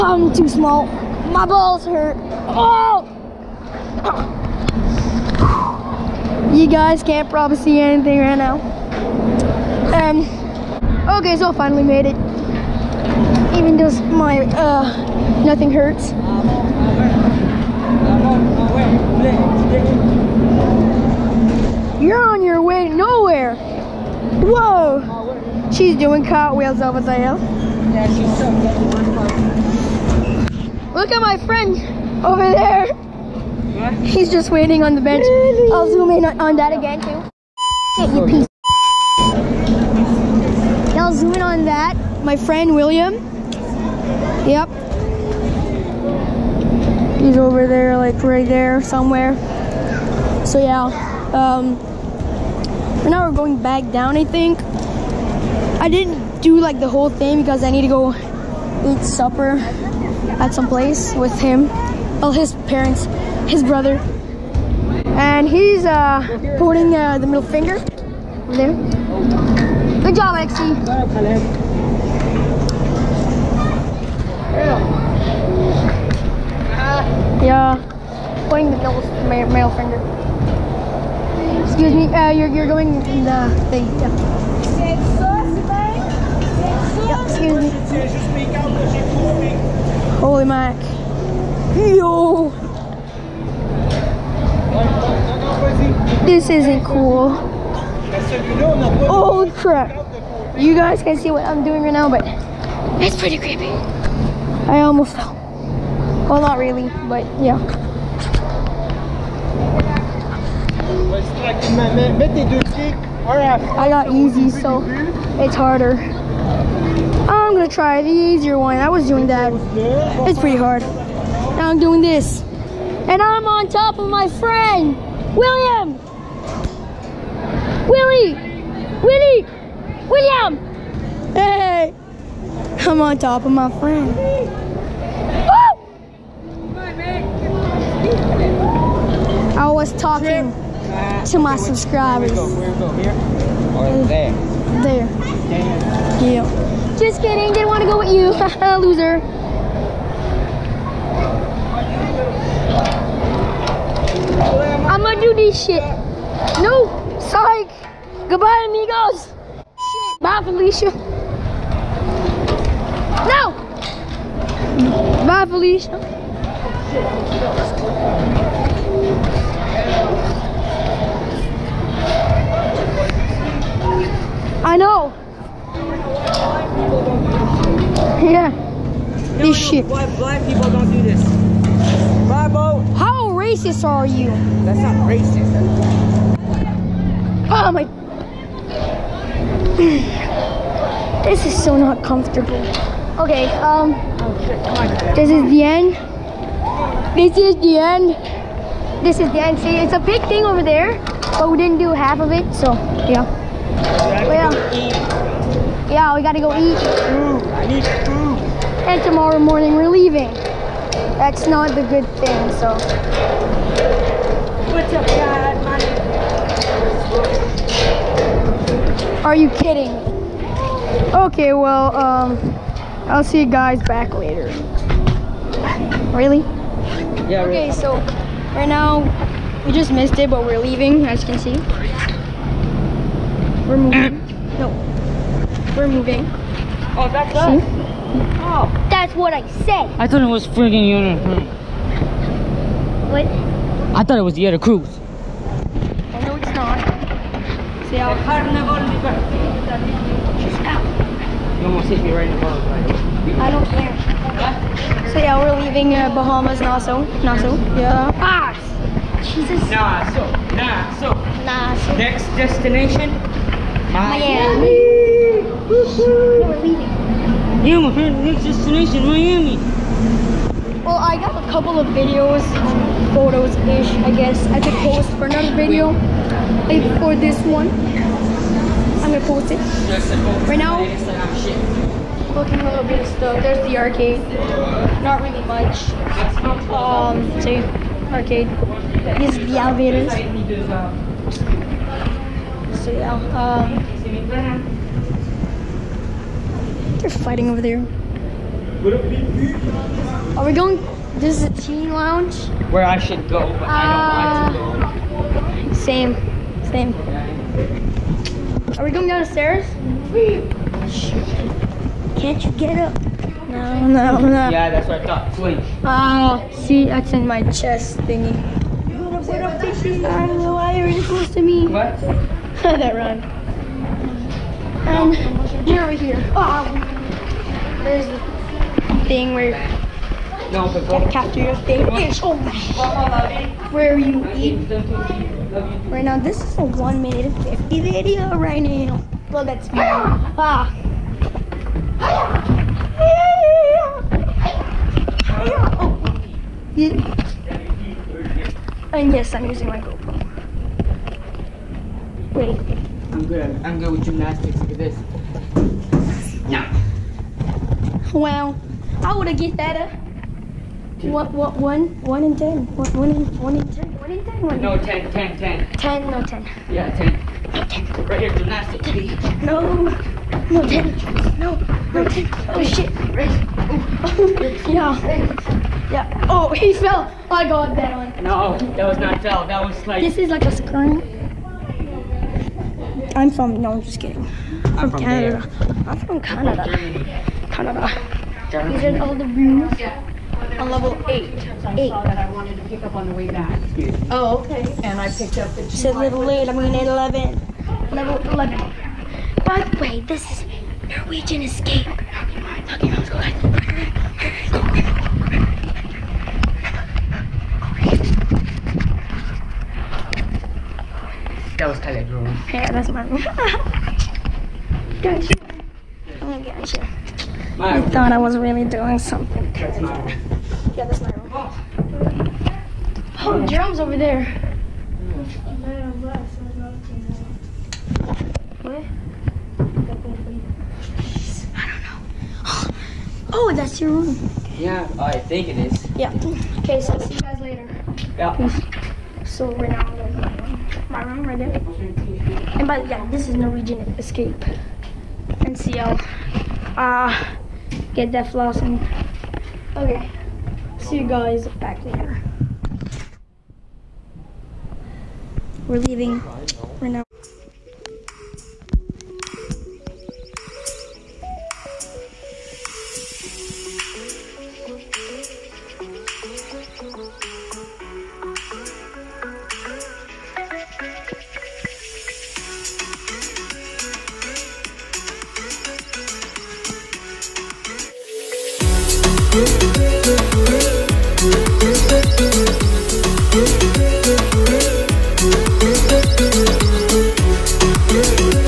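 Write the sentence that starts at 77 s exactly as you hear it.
Yeah, pointing the middle, middle finger.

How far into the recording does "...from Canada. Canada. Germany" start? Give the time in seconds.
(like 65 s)
386 s.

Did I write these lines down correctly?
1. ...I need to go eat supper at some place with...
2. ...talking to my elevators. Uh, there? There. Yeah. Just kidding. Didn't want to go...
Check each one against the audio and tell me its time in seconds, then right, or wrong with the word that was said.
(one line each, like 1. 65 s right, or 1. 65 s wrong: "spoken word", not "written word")
1. 57 s right
2. 139 s wrong: "subscribers", not "elevators".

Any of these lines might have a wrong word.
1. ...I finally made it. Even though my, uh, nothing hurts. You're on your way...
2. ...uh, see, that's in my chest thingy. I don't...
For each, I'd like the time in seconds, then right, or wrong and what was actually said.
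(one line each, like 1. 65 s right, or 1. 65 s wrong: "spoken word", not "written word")
1. 11 s right
2. 316 s right.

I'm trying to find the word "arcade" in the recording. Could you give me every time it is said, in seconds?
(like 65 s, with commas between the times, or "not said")
283 s, 288 s.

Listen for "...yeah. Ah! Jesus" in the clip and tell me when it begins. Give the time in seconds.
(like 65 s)
257 s.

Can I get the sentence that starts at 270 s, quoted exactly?
Well, I got a couple of videos, photos-ish, I guess.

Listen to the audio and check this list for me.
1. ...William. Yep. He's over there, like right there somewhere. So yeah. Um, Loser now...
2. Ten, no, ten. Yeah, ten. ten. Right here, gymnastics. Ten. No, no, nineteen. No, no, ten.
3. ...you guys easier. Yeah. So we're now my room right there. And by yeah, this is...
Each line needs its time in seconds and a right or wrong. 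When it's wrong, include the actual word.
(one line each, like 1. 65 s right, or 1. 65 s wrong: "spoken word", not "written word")
1. 42 s wrong: "Right", not "Loser"
2. 365 s wrong: "ten", not "nineteen"
3. 437 s wrong: "later", not "easier".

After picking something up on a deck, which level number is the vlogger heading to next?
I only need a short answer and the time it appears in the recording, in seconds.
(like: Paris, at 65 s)
11, at 397 s.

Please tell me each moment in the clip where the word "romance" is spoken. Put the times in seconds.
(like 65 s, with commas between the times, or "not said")
not said.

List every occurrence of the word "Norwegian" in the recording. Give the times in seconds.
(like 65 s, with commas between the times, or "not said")
400 s, 443 s.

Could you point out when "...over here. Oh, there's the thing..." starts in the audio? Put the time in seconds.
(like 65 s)
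325 s.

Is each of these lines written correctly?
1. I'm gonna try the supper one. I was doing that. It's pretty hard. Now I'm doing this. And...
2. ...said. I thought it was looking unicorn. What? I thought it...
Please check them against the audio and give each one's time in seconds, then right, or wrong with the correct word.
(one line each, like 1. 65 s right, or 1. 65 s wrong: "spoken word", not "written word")
1. 117 s wrong: "easier", not "supper"
2. 239 s wrong: "freaking", not "looking".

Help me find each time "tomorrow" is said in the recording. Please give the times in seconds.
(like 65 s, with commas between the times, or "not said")
209 s.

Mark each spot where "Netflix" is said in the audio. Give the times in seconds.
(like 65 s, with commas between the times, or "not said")
not said.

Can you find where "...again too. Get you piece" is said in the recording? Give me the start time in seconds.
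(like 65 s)
36 s.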